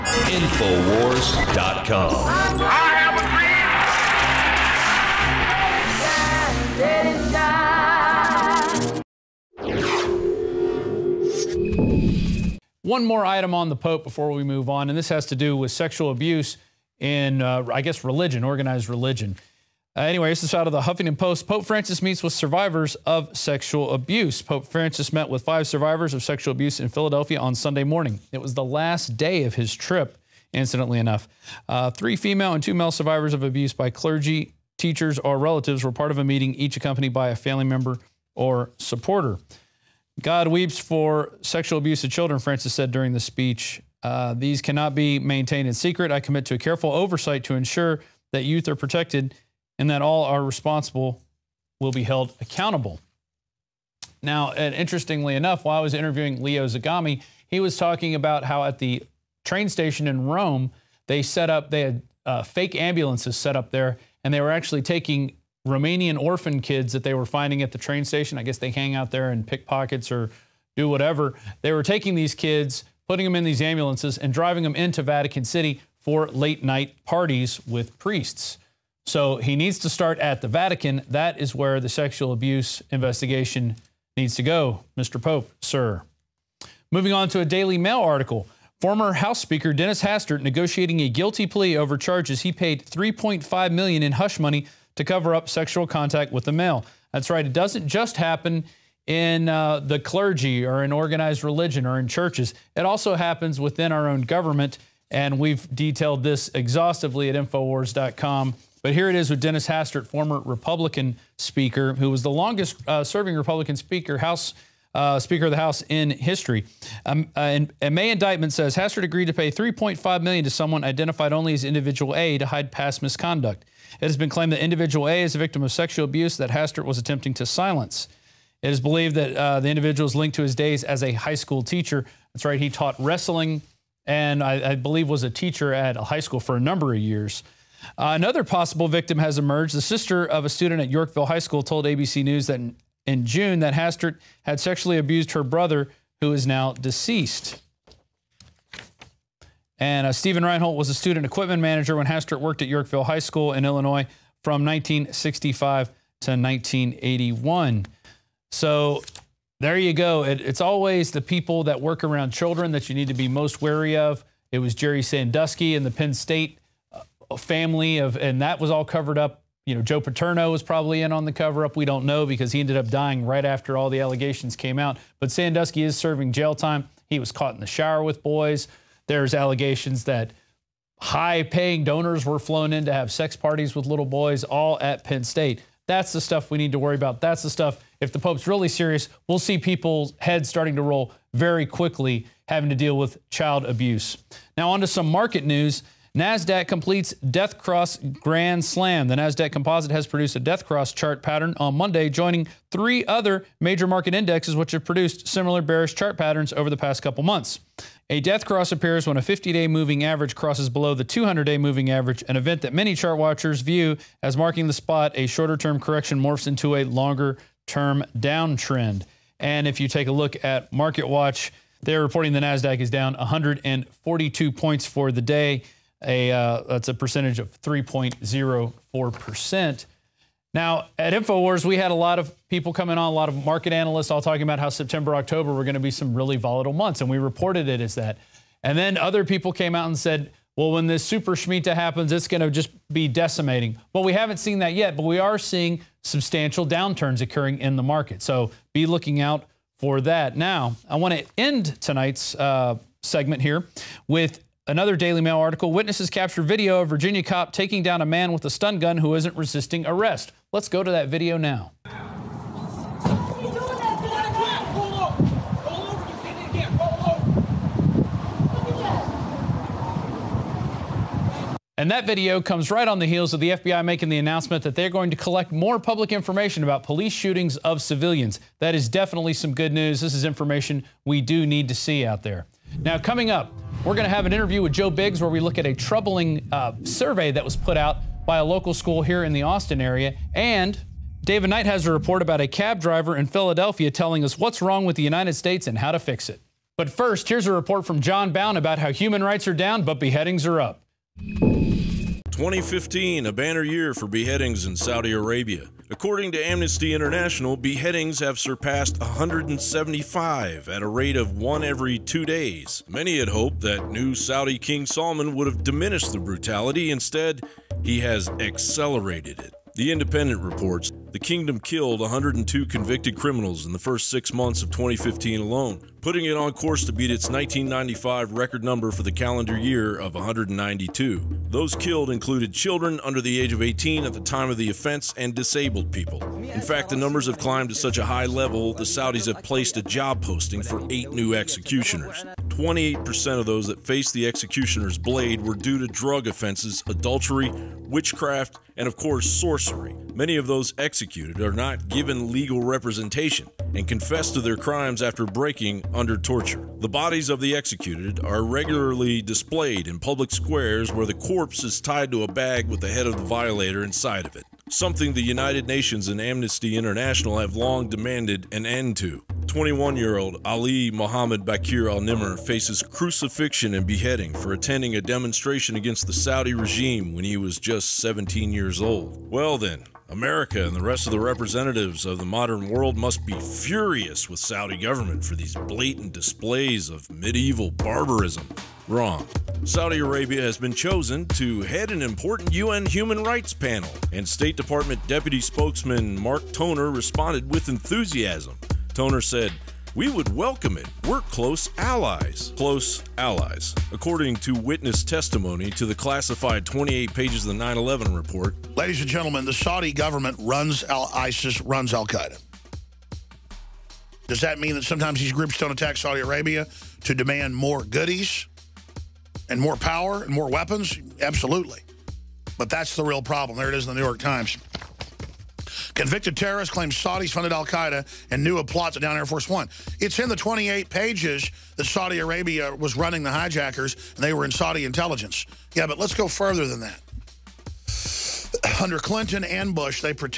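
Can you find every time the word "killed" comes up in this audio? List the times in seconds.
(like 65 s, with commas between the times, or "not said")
321 s, 331 s.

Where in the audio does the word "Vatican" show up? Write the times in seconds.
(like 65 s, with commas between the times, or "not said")
75 s, 80 s.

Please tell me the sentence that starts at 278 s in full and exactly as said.
That is definitely some good news.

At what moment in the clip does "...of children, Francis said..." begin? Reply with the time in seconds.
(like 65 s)
42 s.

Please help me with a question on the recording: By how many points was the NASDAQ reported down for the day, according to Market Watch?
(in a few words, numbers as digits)
142.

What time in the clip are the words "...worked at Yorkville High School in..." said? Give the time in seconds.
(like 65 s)
152 s.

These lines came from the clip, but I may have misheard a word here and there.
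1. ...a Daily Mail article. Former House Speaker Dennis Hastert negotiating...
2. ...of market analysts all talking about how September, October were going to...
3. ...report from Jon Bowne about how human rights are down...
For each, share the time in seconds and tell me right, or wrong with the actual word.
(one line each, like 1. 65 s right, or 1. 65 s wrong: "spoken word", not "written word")
1. 87 s right
2. 233 s right
3. 297 s right.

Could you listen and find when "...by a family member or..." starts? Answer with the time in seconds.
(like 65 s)
37 s.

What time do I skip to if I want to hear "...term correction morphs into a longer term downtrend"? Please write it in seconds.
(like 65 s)
215 s.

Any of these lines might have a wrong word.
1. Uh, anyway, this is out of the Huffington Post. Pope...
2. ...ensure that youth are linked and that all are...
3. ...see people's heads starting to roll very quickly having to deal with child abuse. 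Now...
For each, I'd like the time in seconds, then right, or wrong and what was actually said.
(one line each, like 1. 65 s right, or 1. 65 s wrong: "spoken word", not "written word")
1. 19 s right
2. 47 s wrong: "protected", not "linked"
3. 189 s right.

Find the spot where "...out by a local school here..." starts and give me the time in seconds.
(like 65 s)
287 s.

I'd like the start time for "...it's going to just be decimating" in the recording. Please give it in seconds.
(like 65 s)
242 s.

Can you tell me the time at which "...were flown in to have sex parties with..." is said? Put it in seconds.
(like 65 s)
182 s.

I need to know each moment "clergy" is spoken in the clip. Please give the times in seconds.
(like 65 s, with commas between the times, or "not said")
33 s, 99 s.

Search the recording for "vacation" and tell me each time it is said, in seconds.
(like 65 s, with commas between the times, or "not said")
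not said.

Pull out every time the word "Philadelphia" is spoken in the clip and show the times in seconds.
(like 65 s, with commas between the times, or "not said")
26 s, 293 s.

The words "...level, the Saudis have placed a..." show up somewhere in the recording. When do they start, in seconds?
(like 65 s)
338 s.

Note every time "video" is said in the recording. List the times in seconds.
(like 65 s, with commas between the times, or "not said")
256 s, 261 s, 272 s.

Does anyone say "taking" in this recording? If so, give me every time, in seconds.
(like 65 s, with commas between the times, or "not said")
64 s, 71 s, 257 s.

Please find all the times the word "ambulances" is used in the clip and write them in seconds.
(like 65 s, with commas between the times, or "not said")
62 s, 73 s.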